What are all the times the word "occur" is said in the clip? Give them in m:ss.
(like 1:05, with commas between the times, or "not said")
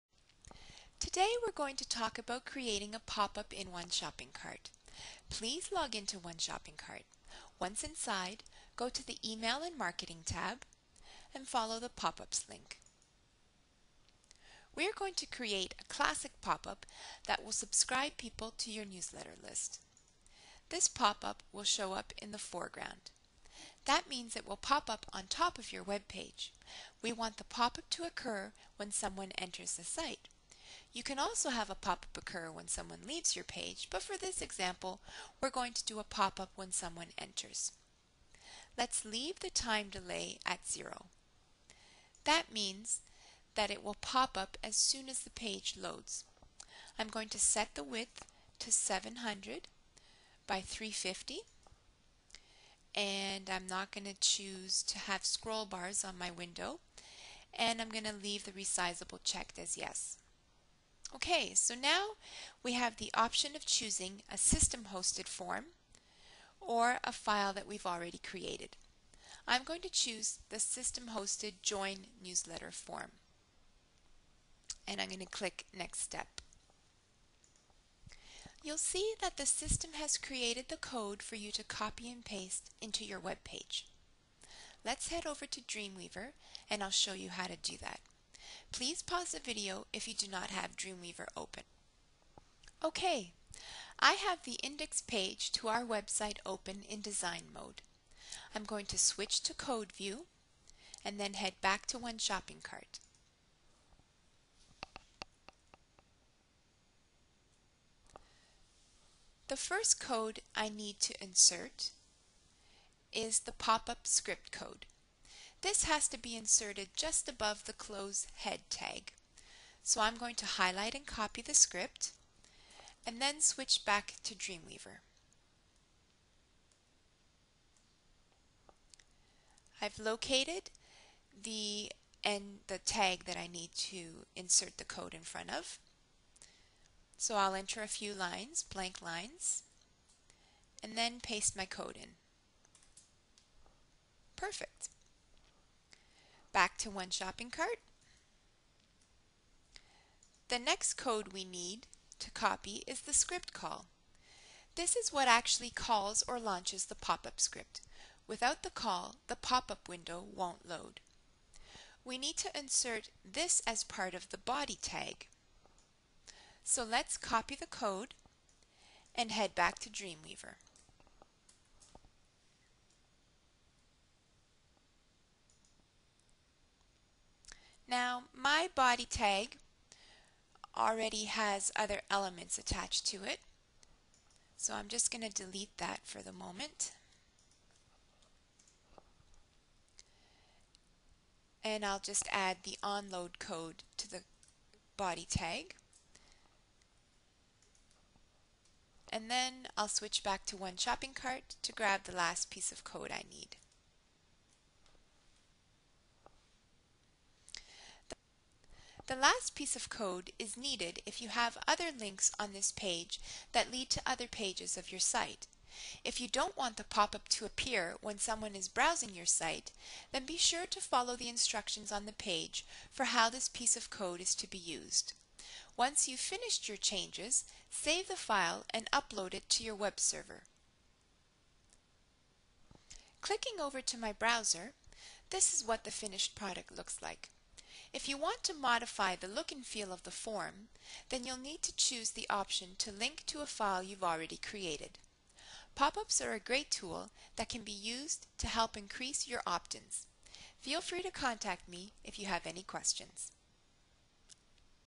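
0:28, 0:32.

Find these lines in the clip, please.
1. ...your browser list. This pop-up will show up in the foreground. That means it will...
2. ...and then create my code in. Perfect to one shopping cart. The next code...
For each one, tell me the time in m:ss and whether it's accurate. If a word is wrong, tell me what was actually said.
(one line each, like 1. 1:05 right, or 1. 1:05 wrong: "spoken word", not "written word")
1. 0:18 wrong: "newsletter", not "browser"
2. 2:20 wrong: "paste", not "create".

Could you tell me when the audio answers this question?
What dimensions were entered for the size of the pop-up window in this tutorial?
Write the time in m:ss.
0:48.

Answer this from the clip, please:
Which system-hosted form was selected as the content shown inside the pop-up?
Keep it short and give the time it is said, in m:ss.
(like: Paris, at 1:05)
join newsletter form, at 1:11.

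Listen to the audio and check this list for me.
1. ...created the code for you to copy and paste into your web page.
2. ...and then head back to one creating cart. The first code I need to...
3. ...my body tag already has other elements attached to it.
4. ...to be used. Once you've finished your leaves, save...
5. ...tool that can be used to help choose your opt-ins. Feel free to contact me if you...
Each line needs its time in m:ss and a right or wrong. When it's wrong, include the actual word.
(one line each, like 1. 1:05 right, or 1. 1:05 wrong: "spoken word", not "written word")
1. 1:20 right
2. 1:41 wrong: "shopping", not "creating"
3. 2:58 right
4. 3:44 wrong: "changes", not "leaves"
5. 4:06 wrong: "increase", not "choose".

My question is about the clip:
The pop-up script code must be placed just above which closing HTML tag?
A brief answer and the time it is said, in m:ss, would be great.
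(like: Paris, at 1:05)
head tag, at 1:57.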